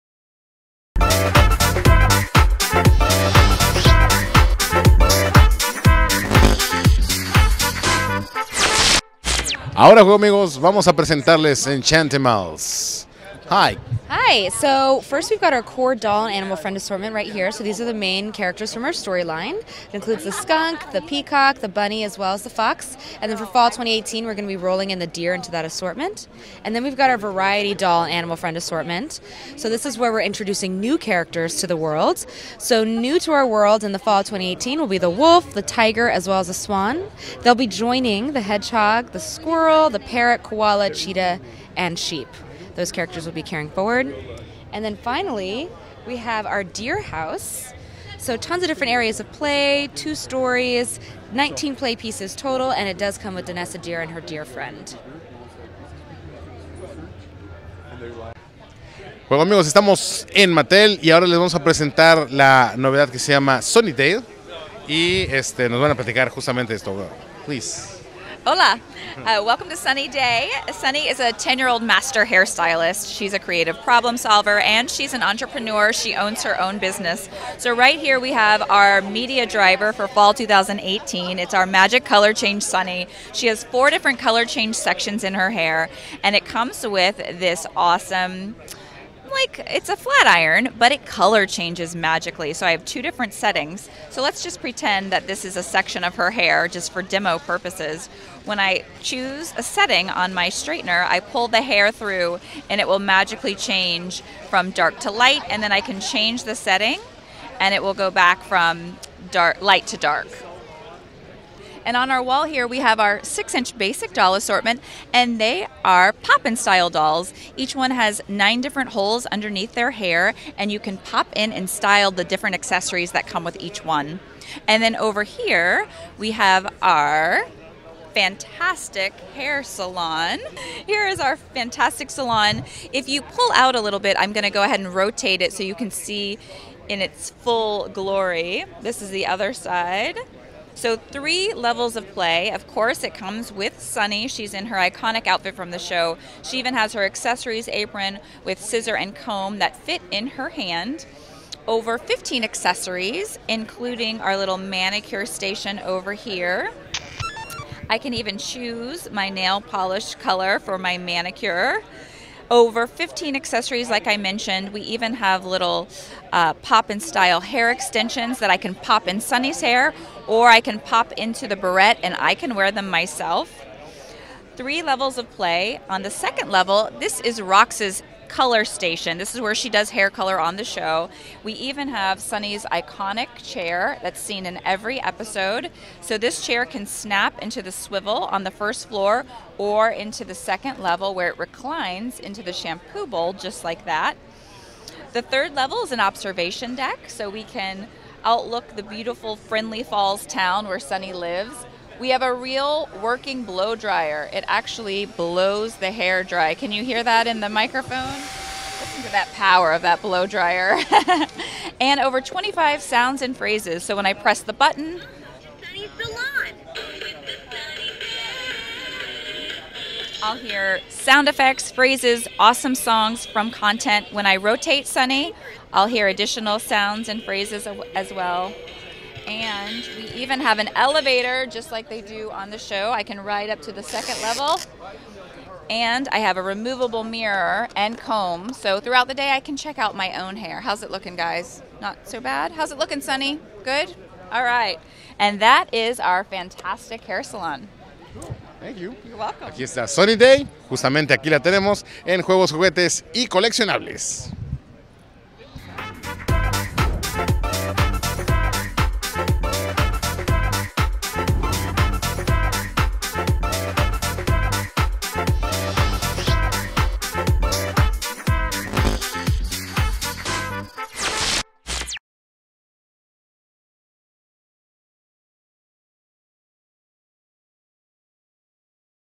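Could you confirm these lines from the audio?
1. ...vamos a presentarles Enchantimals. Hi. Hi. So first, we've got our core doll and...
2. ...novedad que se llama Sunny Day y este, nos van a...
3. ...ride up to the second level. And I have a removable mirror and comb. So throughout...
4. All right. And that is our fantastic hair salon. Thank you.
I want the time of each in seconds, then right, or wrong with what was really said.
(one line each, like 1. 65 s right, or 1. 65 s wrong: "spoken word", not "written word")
1. 10 s right
2. 62 s right
3. 233 s right
4. 244 s right.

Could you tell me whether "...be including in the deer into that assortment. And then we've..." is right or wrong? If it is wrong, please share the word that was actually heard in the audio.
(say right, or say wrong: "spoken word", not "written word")
wrong: "rolling", not "including".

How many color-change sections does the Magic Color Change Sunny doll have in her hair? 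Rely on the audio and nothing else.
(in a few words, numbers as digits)
4.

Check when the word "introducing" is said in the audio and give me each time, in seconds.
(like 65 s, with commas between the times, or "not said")
30 s.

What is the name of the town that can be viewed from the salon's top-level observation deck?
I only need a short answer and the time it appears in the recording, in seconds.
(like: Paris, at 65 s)
Friendly Falls, at 199 s.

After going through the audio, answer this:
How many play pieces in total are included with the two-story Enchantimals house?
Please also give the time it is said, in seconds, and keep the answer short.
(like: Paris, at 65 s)
19, at 51 s.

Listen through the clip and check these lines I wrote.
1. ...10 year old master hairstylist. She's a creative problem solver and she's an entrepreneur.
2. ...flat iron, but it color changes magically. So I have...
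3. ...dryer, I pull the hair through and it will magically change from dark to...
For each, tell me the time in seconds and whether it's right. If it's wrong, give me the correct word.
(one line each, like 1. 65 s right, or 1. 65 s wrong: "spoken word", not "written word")
1. 71 s right
2. 89 s right
3. 100 s wrong: "straightener", not "dryer".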